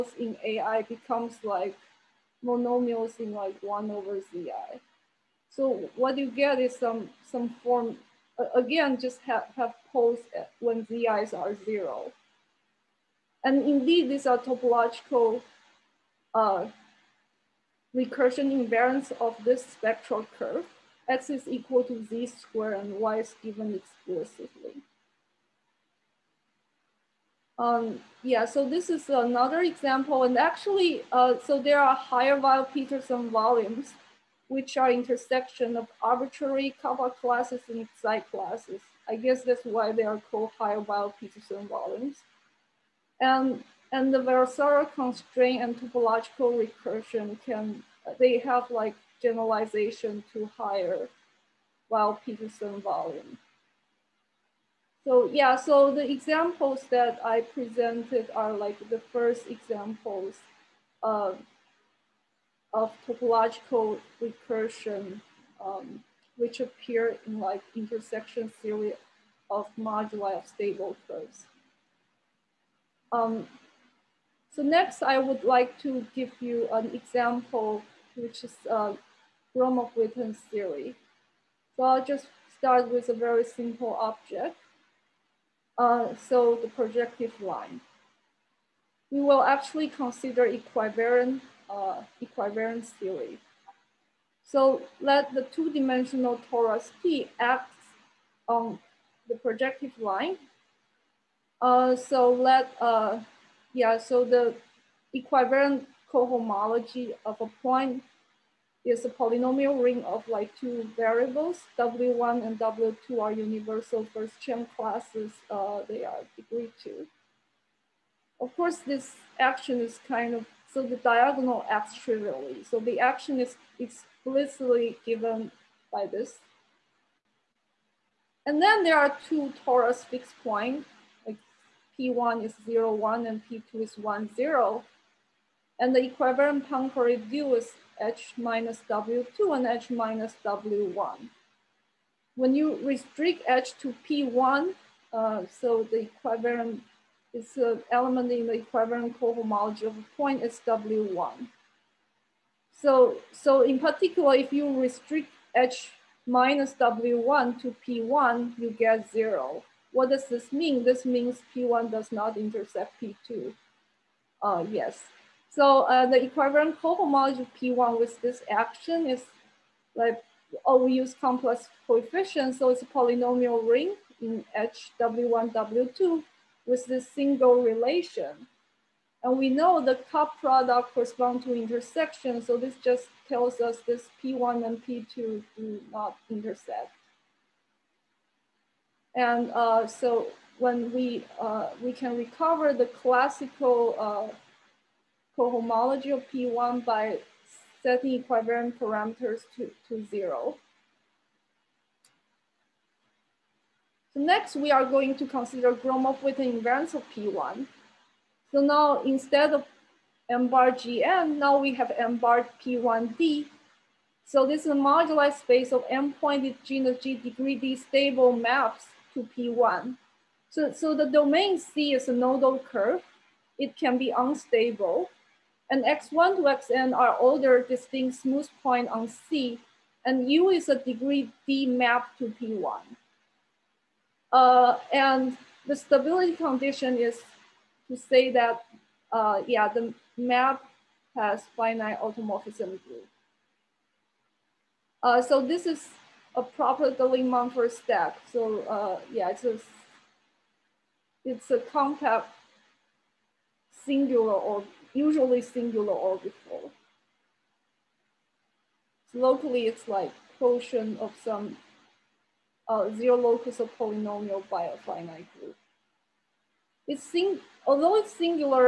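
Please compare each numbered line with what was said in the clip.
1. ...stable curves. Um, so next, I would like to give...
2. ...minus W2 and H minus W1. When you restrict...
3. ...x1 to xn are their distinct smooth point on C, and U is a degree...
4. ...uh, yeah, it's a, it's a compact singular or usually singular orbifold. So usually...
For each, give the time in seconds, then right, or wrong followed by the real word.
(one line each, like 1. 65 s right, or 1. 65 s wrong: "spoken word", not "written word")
1. 70 s right
2. 138 s right
3. 225 s right
4. 248 s wrong: "locally", not "usually".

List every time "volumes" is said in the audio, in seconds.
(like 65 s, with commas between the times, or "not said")
33 s, 41 s, 52 s.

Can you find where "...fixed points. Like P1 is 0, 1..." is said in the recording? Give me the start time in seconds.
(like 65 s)
130 s.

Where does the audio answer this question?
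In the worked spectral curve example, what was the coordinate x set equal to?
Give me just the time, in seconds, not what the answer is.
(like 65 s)
21 s.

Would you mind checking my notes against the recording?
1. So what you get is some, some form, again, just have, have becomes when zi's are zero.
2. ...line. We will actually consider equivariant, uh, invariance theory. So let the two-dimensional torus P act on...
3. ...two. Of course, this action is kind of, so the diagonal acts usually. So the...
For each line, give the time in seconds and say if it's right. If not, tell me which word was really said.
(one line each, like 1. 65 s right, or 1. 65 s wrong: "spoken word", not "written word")
1. 5 s wrong: "poles", not "becomes"
2. 87 s wrong: "equivariance", not "invariance"
3. 116 s wrong: "trivially", not "usually".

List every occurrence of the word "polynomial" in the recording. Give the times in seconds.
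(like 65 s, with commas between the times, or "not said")
109 s, 172 s, 263 s.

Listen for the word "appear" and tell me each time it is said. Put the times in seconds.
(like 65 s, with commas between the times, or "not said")
66 s.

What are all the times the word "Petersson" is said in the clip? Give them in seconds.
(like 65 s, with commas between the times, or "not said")
32 s, 40 s, 51 s.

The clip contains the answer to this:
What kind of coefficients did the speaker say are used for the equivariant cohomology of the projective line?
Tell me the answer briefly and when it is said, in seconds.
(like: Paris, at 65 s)
Complex coefficients, at 171 s.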